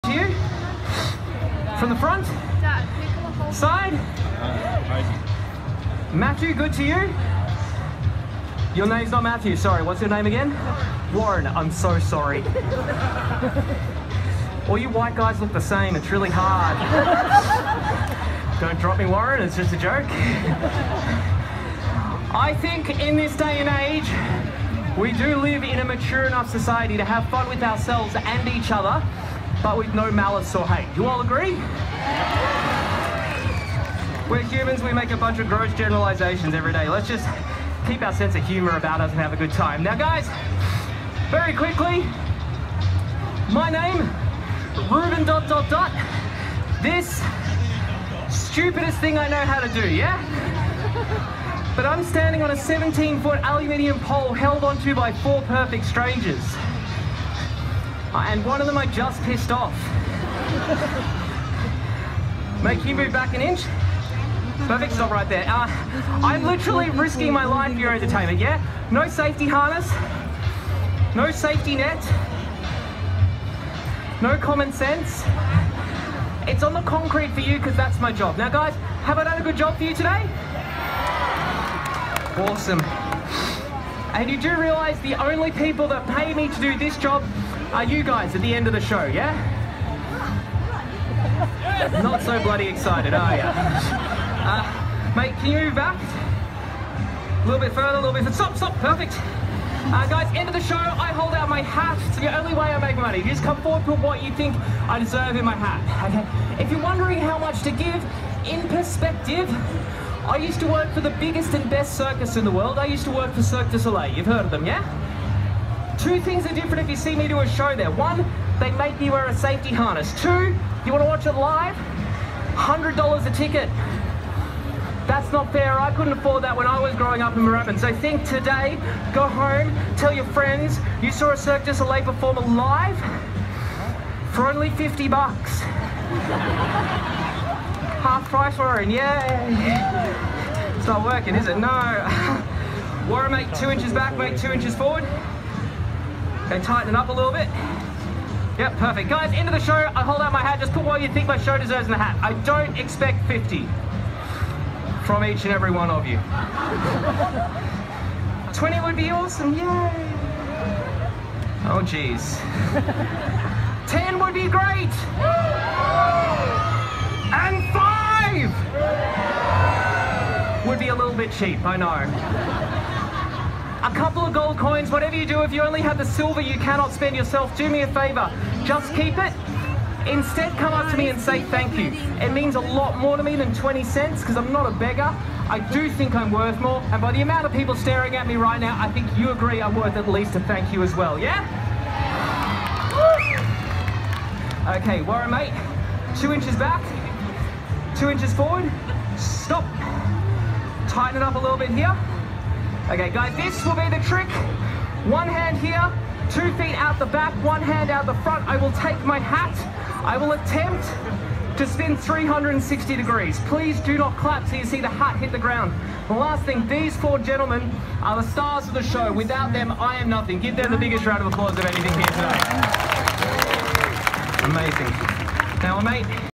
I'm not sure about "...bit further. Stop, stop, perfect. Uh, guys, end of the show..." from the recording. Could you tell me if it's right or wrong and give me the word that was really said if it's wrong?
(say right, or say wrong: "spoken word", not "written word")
right.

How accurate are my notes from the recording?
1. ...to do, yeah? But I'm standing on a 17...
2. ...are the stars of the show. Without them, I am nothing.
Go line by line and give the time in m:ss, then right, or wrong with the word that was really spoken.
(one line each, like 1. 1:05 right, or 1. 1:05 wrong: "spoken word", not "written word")
1. 0:49 right
2. 3:38 right.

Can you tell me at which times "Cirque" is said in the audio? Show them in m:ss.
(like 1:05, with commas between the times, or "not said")
1:53, 2:11.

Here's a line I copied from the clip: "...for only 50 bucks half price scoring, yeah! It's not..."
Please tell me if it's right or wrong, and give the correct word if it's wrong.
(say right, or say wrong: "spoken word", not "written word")
right.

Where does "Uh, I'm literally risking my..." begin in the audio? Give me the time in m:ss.
1:05.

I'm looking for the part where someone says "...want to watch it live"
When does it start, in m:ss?
2:00.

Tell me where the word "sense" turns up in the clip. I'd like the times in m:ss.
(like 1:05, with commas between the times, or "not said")
0:38, 1:14.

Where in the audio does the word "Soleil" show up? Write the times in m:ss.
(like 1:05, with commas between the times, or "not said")
1:53, 2:11.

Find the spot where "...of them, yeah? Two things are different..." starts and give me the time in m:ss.
1:54.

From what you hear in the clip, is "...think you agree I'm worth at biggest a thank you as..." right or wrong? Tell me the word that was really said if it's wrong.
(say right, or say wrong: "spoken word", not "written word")
wrong: "least", not "biggest".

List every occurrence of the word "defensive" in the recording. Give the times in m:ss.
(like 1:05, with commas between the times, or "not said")
not said.